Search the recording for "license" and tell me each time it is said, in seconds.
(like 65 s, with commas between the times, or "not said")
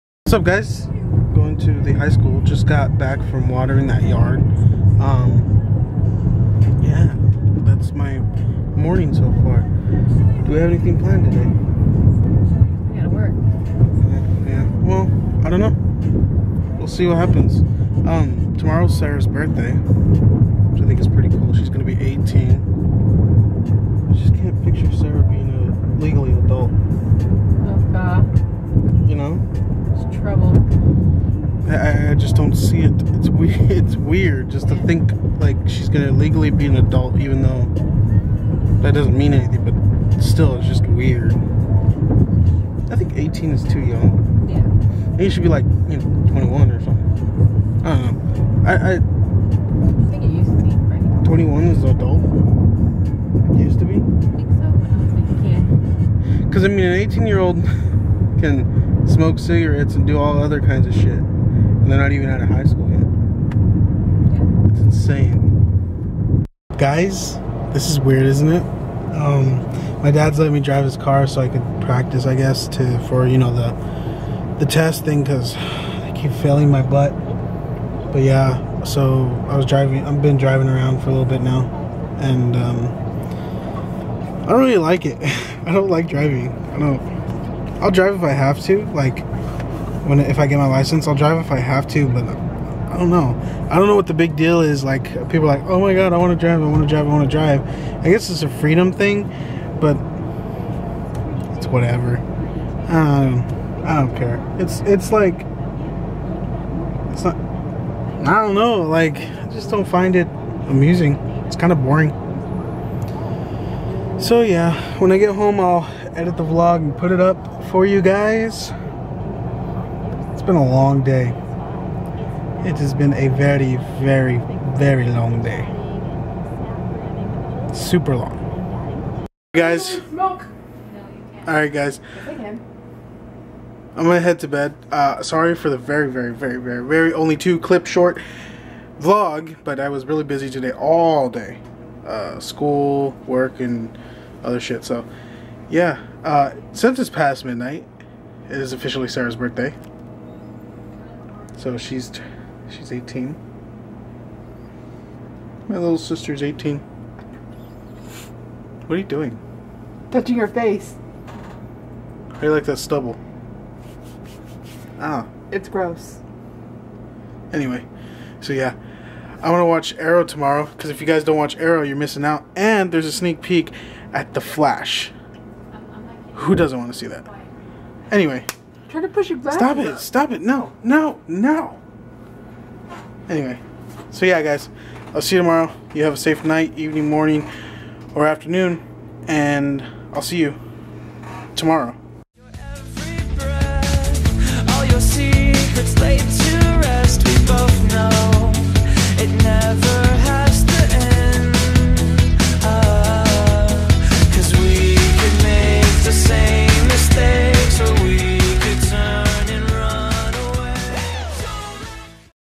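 90 s.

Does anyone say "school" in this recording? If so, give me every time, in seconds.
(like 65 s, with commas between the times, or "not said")
2 s, 62 s, 142 s.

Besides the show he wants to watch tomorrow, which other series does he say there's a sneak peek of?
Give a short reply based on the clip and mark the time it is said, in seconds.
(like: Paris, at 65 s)
The Flash, at 174 s.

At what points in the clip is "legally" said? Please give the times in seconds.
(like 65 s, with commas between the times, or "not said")
26 s, 36 s.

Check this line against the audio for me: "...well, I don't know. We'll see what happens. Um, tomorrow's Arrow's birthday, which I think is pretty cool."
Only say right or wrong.
wrong.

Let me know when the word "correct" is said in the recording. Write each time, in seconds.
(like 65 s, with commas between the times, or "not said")
not said.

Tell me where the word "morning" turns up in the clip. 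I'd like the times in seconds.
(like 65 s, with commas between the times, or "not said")
8 s, 187 s.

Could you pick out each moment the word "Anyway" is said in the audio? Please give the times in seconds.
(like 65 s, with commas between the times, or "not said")
167 s, 178 s, 183 s.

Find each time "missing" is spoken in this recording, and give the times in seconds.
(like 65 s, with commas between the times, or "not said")
171 s.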